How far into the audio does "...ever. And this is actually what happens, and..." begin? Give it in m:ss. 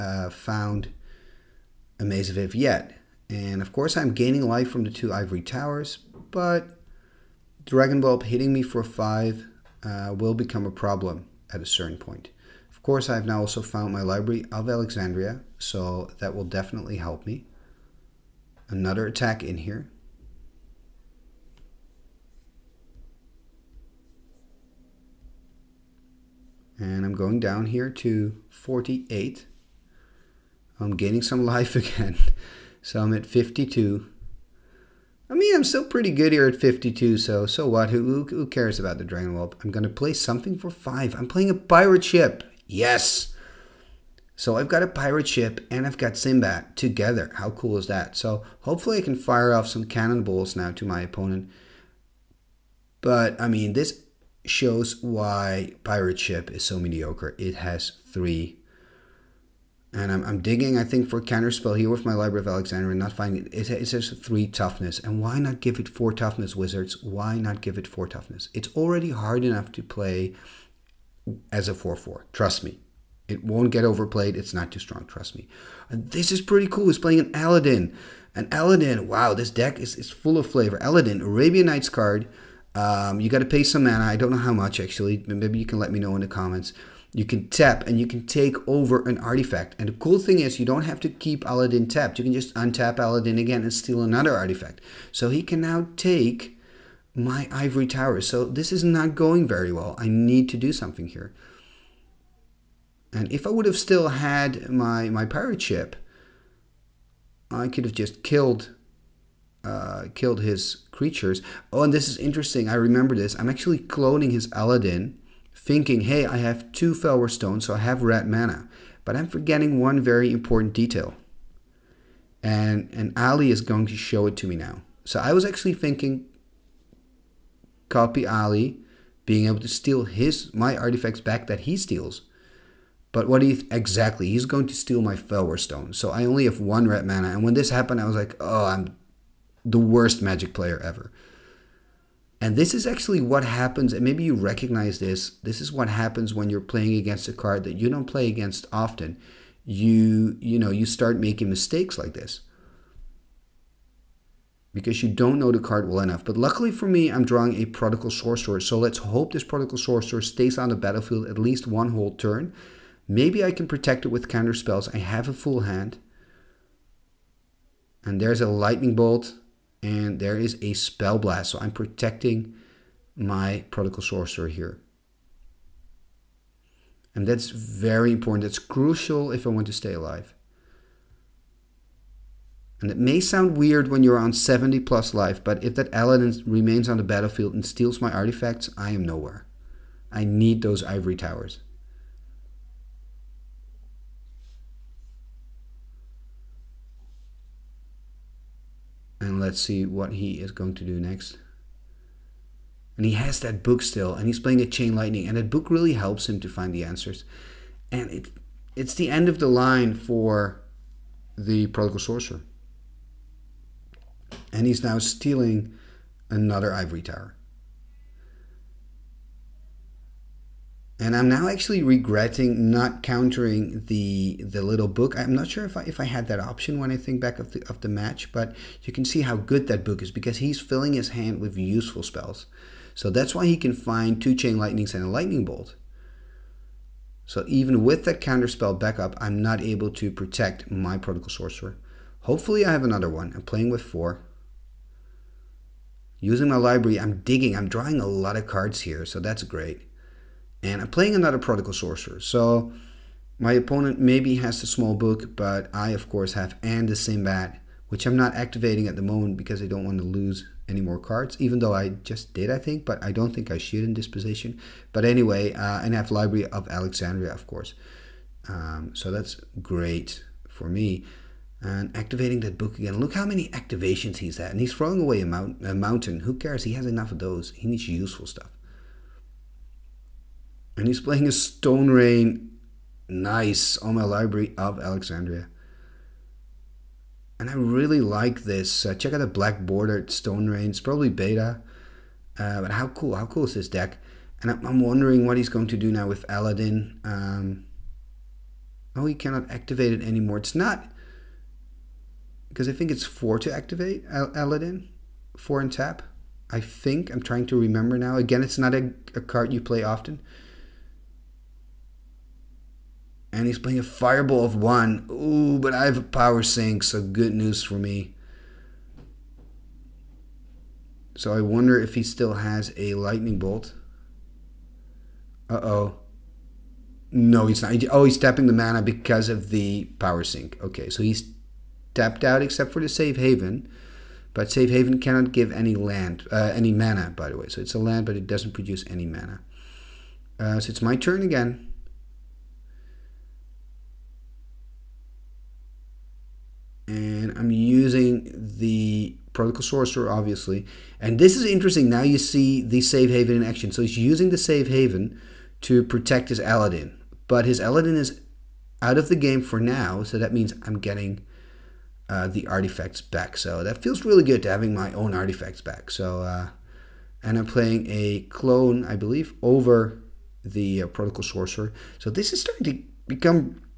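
2:20.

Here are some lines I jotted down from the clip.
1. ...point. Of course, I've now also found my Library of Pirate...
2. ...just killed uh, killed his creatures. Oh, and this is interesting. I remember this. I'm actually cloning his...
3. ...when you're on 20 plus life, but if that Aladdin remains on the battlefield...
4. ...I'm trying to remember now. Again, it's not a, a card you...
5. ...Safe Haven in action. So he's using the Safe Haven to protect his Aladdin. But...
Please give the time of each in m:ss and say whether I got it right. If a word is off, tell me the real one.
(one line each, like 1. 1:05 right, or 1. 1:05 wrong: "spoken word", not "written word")
1. 0:11 wrong: "Alexandria", not "Pirate"
2. 1:47 right
3. 3:03 wrong: "70", not "20"
4. 5:07 right
5. 5:52 right.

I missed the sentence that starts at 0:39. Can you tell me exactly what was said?
I'm going to play something for 5.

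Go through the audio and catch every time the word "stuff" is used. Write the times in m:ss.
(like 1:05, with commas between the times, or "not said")
4:38.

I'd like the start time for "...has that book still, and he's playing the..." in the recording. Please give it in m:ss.
3:23.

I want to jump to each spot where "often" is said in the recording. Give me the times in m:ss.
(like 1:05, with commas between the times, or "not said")
2:28, 5:09.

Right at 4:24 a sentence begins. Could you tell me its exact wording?
But anyway, uh, and I have Library of Alexandria, of course.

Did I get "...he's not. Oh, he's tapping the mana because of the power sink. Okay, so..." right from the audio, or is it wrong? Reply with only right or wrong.
right.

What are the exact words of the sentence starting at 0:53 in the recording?
But, I mean, this shows why Pirate Ship is so mediocre.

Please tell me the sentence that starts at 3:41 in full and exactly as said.
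and I'm now actually regretting not countering the the little book.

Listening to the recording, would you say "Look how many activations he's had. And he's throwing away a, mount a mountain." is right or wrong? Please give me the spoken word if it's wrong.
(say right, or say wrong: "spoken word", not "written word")
right.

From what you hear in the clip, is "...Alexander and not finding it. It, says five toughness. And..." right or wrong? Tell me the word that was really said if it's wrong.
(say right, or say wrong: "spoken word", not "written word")
wrong: "three", not "five".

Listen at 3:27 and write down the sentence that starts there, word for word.
And it, it's the end of the line for the prodigal sorcerer.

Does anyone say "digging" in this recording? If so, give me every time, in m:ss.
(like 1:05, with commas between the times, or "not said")
1:00, 4:07.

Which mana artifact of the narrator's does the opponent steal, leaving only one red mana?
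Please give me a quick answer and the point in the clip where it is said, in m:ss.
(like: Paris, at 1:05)
Fellwar Stone, at 2:15.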